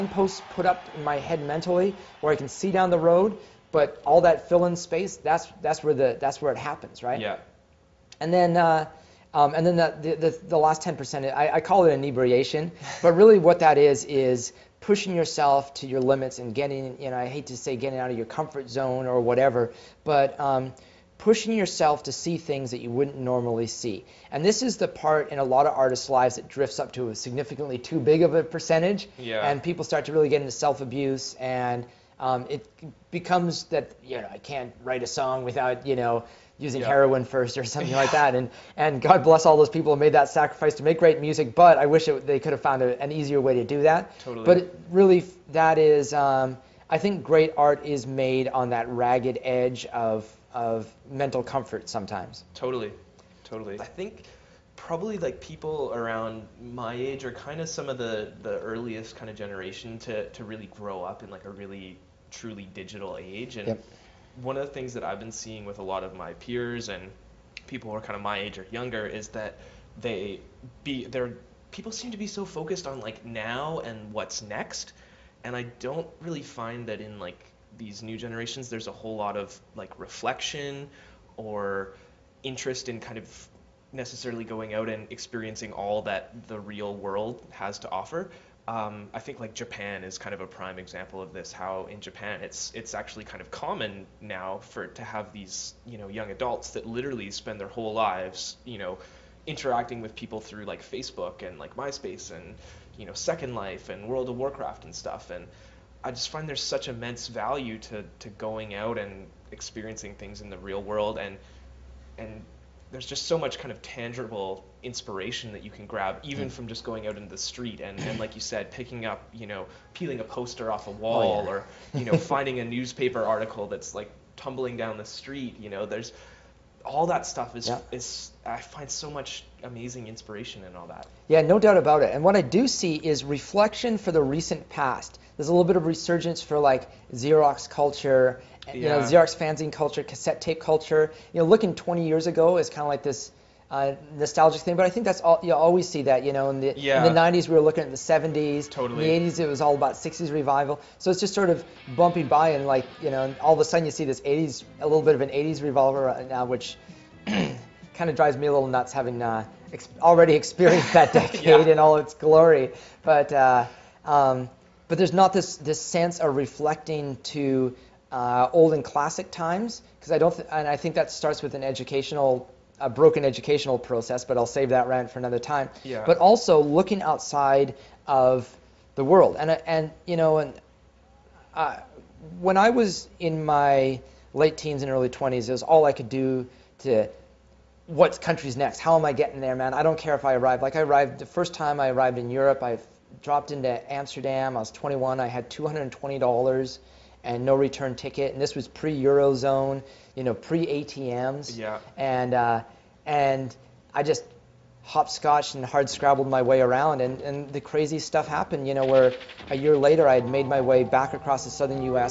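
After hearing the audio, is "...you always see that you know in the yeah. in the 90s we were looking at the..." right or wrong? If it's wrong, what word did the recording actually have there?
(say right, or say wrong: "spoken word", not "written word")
right.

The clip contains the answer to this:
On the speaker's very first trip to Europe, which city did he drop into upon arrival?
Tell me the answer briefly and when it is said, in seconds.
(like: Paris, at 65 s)
Amsterdam, at 193 s.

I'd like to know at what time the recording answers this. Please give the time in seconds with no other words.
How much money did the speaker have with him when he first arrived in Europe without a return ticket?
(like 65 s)
195 s.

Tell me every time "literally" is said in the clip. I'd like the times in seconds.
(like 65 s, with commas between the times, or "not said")
96 s.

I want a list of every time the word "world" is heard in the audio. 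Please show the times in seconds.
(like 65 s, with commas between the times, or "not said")
86 s, 104 s, 110 s, 179 s.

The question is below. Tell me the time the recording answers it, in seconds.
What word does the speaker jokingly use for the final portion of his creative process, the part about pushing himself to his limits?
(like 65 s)
11 s.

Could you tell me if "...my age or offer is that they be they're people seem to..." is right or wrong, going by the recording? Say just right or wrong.
wrong.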